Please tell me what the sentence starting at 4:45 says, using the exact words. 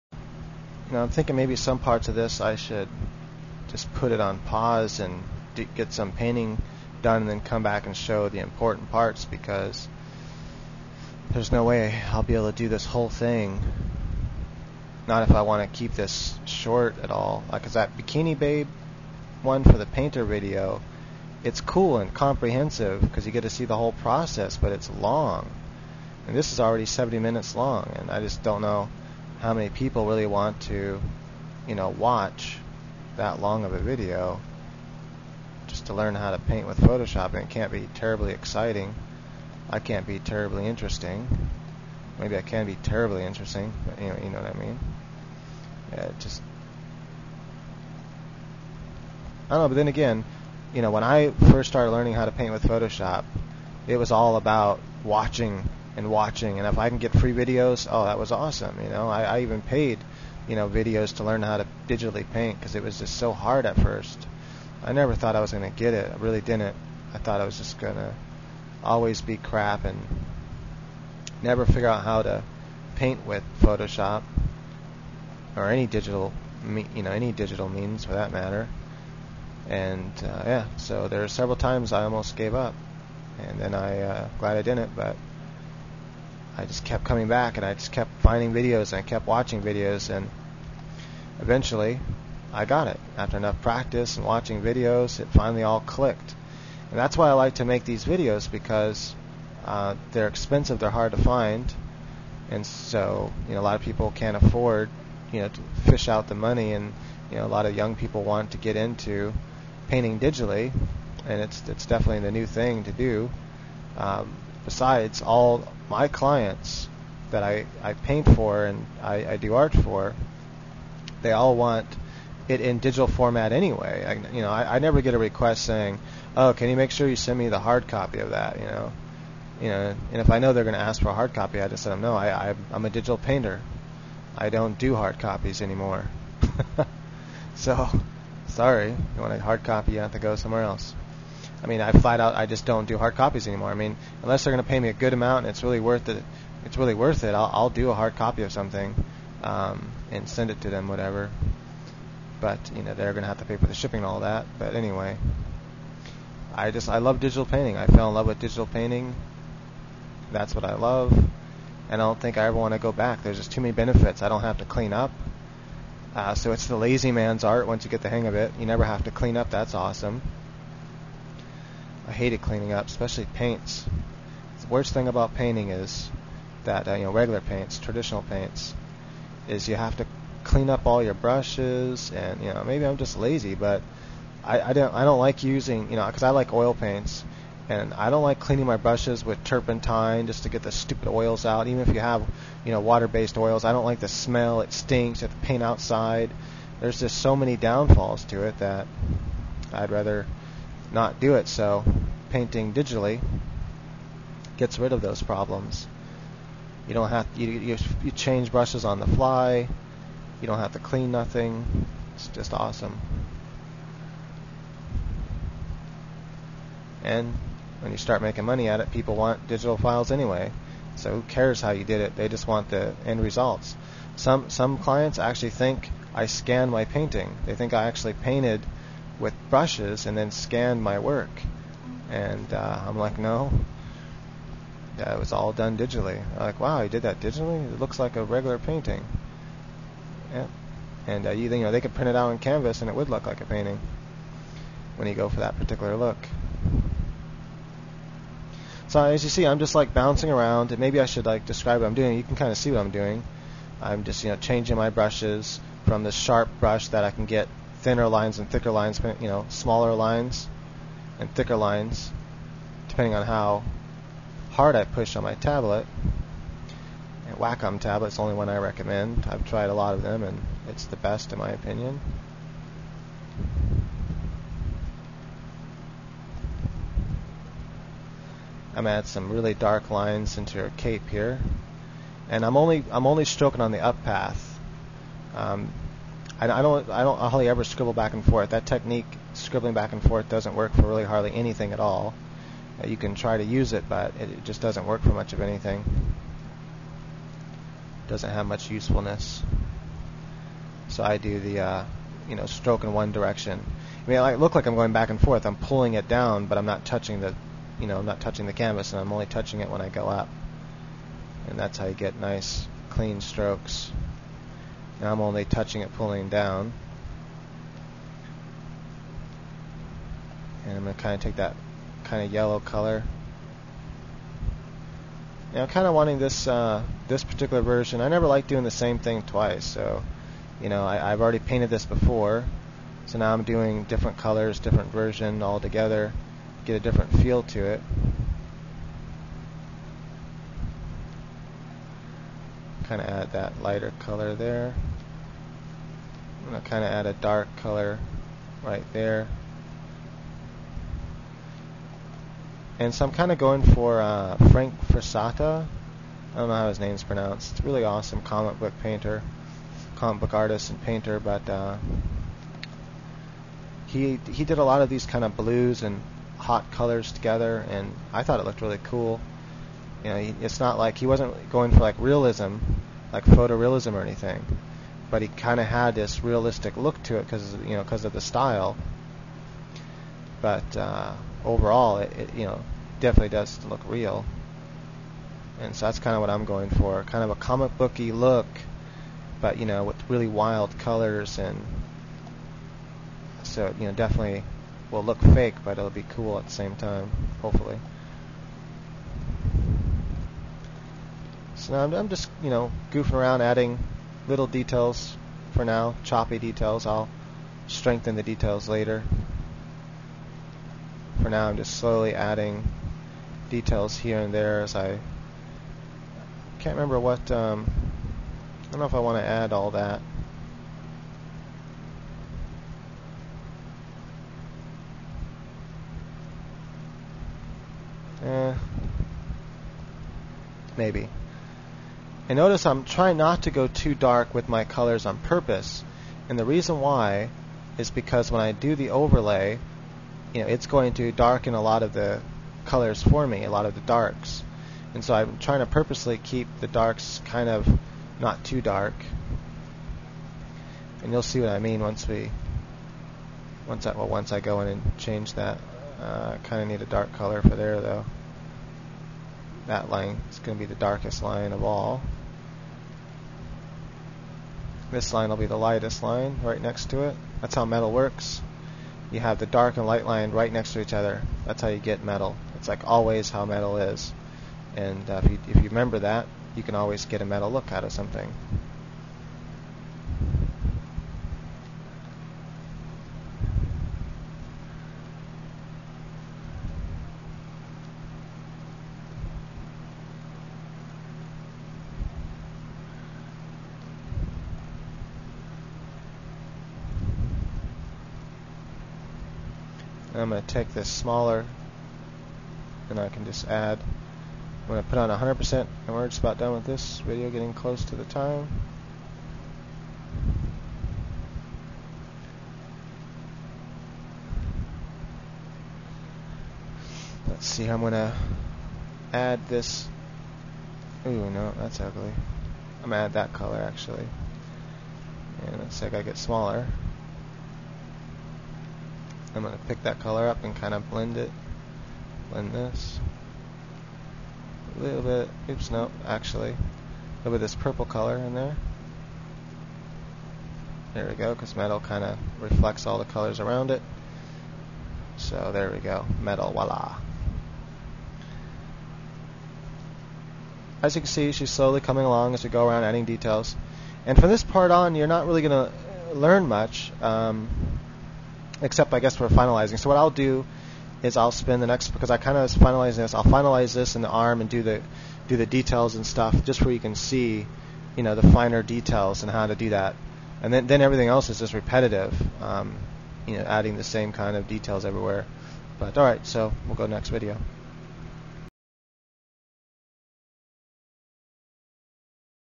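Um, I, I, don't I don't hardly ever scribble back and forth.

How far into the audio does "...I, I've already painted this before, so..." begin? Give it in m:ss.
5:30.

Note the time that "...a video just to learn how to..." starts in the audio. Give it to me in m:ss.
0:33.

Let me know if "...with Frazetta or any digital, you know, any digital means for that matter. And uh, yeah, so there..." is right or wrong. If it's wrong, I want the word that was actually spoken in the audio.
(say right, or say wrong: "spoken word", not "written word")
wrong: "Photoshop", not "Frazetta".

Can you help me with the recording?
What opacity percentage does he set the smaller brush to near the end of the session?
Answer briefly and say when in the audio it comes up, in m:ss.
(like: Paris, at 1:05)
100%, at 8:25.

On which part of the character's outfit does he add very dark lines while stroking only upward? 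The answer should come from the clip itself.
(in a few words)
her cape.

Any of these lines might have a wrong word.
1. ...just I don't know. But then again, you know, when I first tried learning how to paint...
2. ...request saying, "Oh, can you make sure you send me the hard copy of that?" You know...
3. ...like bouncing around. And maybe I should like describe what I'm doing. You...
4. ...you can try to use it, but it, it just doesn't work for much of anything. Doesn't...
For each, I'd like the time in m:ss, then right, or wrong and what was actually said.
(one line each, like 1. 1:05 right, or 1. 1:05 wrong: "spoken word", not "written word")
1. 0:46 wrong: "started", not "tried"
2. 2:05 right
3. 4:09 right
4. 4:52 right.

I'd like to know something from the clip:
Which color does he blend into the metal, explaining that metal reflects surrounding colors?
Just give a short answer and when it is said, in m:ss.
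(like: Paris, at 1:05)
purple, at 8:57.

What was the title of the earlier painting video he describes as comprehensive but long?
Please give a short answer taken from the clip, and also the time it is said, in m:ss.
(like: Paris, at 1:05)
Bikini Babe, at 0:17.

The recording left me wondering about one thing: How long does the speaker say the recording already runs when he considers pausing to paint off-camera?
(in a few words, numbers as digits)
70 minutes.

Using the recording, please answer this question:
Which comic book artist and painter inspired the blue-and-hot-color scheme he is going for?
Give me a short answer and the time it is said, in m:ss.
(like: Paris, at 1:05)
Frank Frazetta, at 5:54.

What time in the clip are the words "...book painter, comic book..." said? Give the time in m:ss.
5:58.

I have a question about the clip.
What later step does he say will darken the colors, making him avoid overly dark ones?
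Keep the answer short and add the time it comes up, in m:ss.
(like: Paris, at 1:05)
overlay, at 7:18.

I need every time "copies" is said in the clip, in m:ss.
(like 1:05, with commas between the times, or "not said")
2:15, 2:23.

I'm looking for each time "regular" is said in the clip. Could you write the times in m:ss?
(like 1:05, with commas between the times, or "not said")
2:57, 3:58.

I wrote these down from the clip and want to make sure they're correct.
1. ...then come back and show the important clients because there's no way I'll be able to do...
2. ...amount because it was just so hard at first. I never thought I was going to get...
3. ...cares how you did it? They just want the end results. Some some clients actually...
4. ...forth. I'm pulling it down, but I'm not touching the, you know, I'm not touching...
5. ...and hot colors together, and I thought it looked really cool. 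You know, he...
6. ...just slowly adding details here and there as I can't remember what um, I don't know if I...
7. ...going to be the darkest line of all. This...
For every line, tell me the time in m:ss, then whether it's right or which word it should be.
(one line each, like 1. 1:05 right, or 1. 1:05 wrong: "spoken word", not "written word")
1. 0:07 wrong: "parts", not "clients"
2. 1:02 wrong: "paint", not "amount"
3. 3:41 right
4. 5:05 right
5. 6:05 right
6. 6:51 right
7. 7:40 right.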